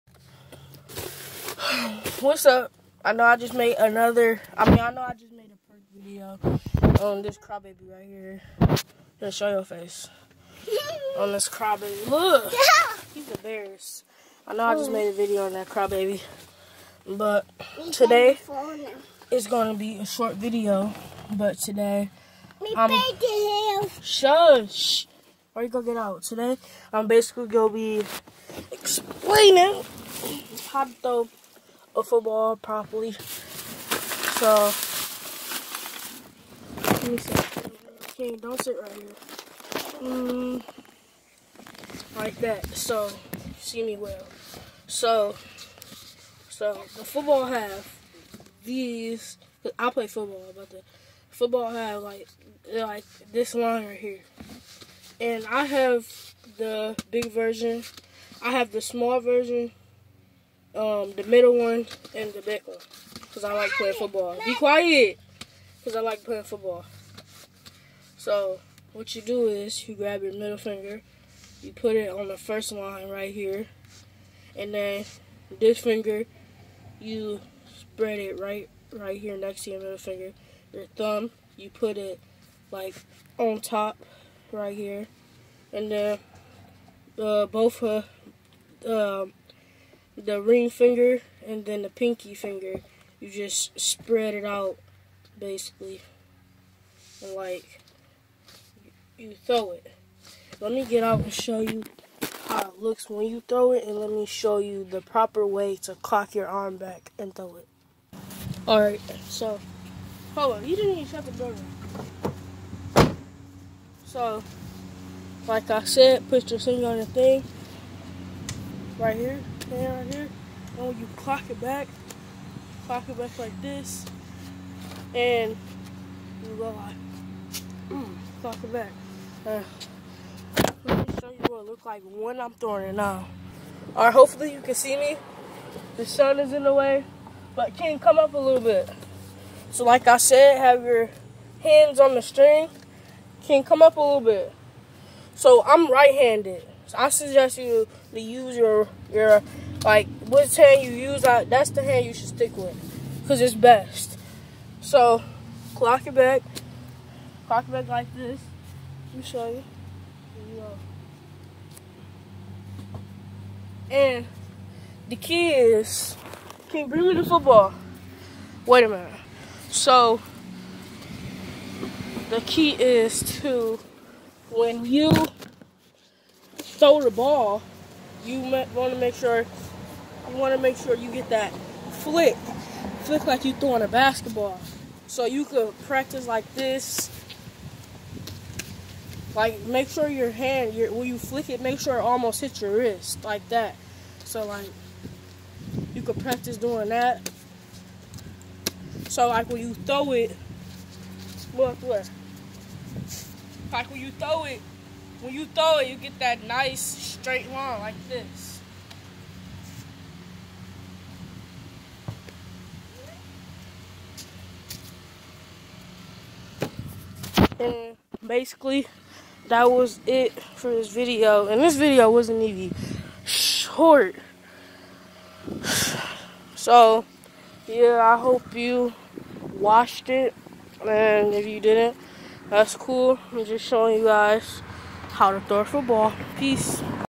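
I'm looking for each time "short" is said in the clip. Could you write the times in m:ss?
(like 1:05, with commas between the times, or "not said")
0:20, 3:43.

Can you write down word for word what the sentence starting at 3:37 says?
And basically, that was it for this video.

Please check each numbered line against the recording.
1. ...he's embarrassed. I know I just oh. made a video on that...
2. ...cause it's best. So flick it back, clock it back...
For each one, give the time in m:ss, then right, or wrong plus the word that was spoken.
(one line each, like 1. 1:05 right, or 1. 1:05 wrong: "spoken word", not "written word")
1. 0:13 right
2. 2:33 wrong: "clock", not "flick".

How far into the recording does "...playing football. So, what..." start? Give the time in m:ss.
1:06.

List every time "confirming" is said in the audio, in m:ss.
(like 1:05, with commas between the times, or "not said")
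not said.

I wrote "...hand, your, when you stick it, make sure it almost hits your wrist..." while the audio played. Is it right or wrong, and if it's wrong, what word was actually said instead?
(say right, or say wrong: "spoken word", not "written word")
wrong: "flick", not "stick".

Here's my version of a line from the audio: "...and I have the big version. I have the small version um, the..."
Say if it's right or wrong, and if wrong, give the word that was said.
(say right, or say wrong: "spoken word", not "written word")
right.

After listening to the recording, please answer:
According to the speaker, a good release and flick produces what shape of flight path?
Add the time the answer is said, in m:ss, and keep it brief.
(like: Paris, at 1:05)
Nice straight line, at 3:26.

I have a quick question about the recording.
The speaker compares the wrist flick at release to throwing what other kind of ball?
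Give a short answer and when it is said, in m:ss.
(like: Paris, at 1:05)
A basketball, at 3:03.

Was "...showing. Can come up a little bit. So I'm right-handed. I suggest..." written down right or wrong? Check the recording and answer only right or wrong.
wrong.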